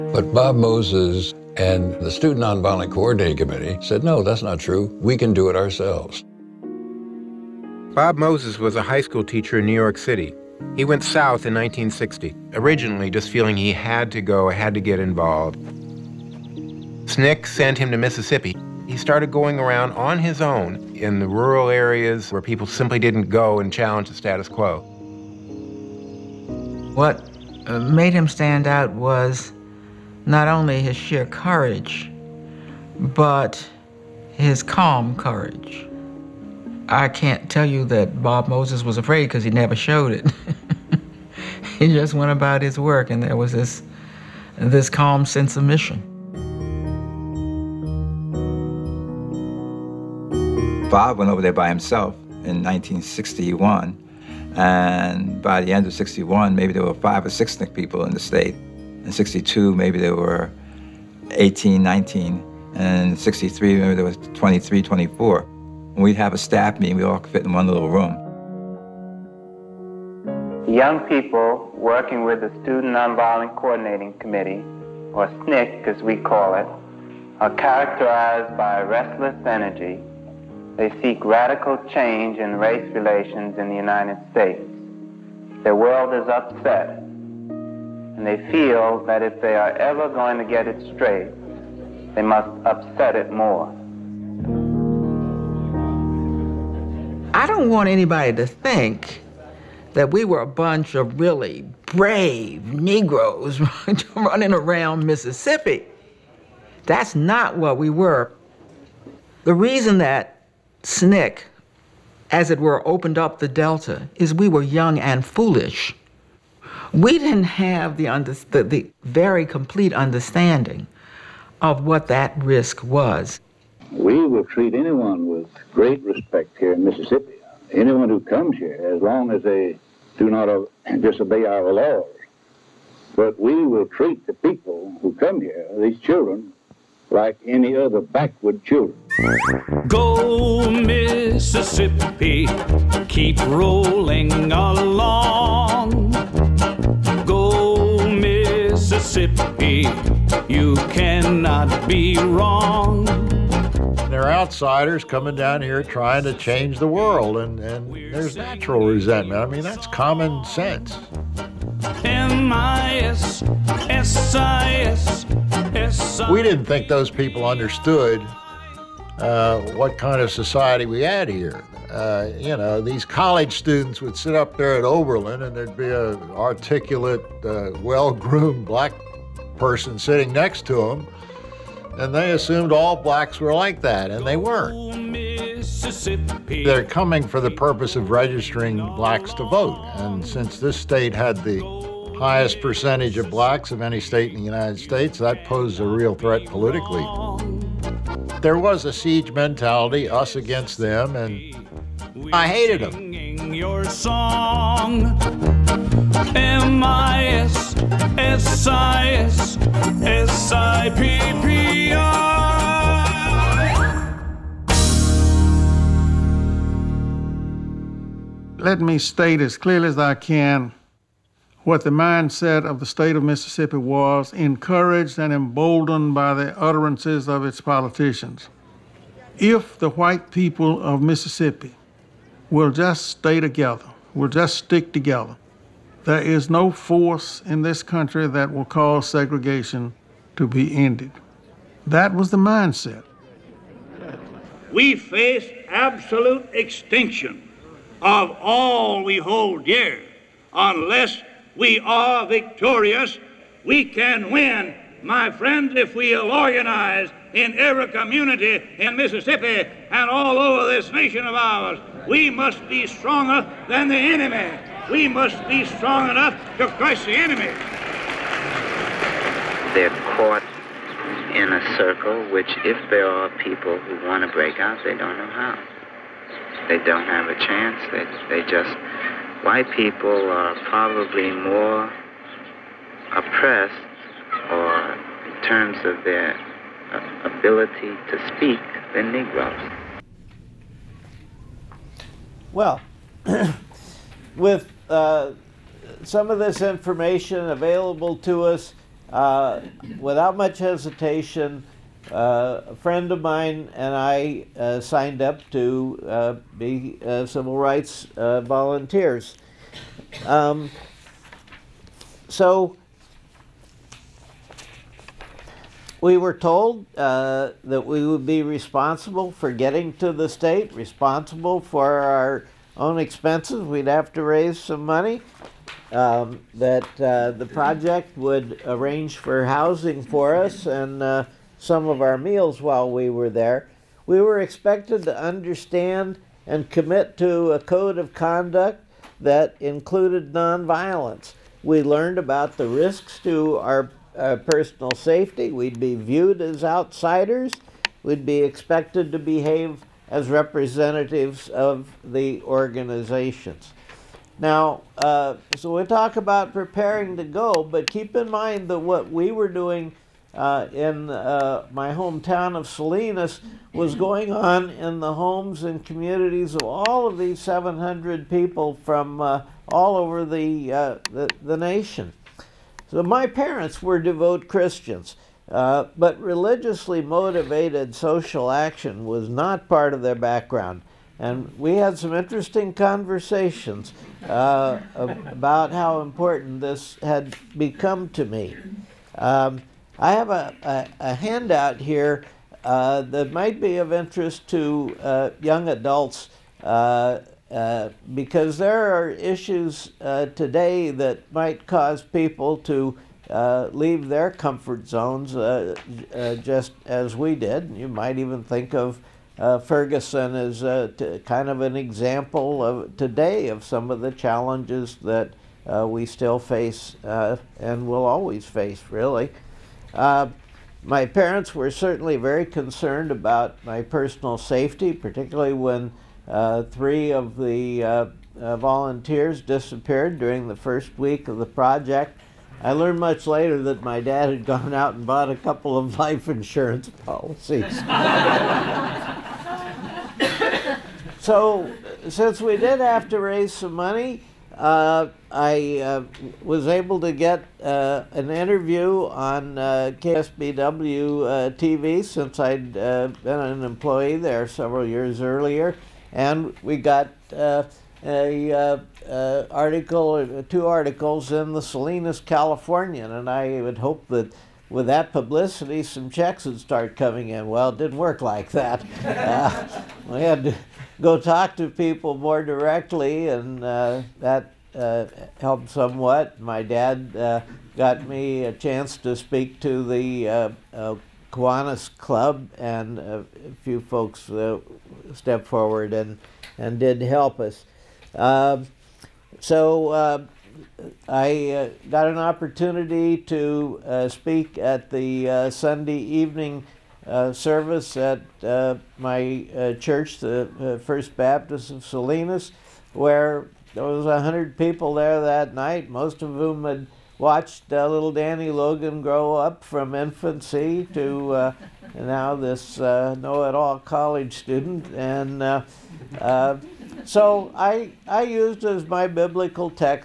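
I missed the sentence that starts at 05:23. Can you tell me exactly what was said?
We'd have to raise some money.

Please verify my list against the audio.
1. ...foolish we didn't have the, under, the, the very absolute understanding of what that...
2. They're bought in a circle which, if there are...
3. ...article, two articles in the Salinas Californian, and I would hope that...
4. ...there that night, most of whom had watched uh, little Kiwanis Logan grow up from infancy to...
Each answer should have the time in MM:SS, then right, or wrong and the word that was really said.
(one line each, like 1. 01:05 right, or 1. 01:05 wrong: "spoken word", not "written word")
1. 01:55 wrong: "complete", not "absolute"
2. 04:29 wrong: "caught", not "bought"
3. 07:39 right
4. 08:24 wrong: "Danny", not "Kiwanis".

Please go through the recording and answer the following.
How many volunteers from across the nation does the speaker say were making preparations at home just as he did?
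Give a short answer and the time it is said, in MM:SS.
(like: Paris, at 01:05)
700, at 06:07.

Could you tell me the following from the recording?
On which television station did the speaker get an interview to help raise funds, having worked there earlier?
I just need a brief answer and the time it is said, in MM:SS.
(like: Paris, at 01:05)
KSBW, at 07:29.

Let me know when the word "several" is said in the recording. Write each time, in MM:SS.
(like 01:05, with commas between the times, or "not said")
07:34.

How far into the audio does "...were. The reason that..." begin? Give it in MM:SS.
01:47.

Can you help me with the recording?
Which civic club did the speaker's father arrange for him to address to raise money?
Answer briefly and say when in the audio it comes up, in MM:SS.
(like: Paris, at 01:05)
Kiwanis Club, at 08:01.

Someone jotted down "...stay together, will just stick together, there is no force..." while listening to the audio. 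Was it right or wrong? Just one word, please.
right.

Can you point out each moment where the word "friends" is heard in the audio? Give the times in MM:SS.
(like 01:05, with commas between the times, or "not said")
04:15, 05:02.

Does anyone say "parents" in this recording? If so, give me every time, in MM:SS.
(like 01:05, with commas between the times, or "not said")
06:13, 07:01.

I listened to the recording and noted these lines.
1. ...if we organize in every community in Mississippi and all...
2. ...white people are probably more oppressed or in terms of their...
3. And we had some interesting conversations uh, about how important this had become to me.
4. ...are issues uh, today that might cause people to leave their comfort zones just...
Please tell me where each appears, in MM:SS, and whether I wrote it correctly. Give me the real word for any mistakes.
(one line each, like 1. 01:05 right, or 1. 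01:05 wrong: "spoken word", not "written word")
1. 04:15 right
2. 04:39 right
3. 06:21 right
4. 06:38 right.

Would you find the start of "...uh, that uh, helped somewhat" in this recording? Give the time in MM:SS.
07:53.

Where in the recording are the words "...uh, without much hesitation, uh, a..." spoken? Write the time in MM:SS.
04:59.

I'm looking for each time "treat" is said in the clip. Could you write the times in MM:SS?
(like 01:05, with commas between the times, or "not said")
02:04, 02:13.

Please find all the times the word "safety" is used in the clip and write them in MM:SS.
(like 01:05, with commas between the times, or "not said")
05:44, 07:04.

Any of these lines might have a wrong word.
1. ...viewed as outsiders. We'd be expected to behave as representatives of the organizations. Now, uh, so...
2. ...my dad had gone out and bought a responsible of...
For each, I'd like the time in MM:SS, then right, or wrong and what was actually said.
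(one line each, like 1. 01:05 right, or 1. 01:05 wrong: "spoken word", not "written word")
1. 05:45 right
2. 07:13 wrong: "couple", not "responsible".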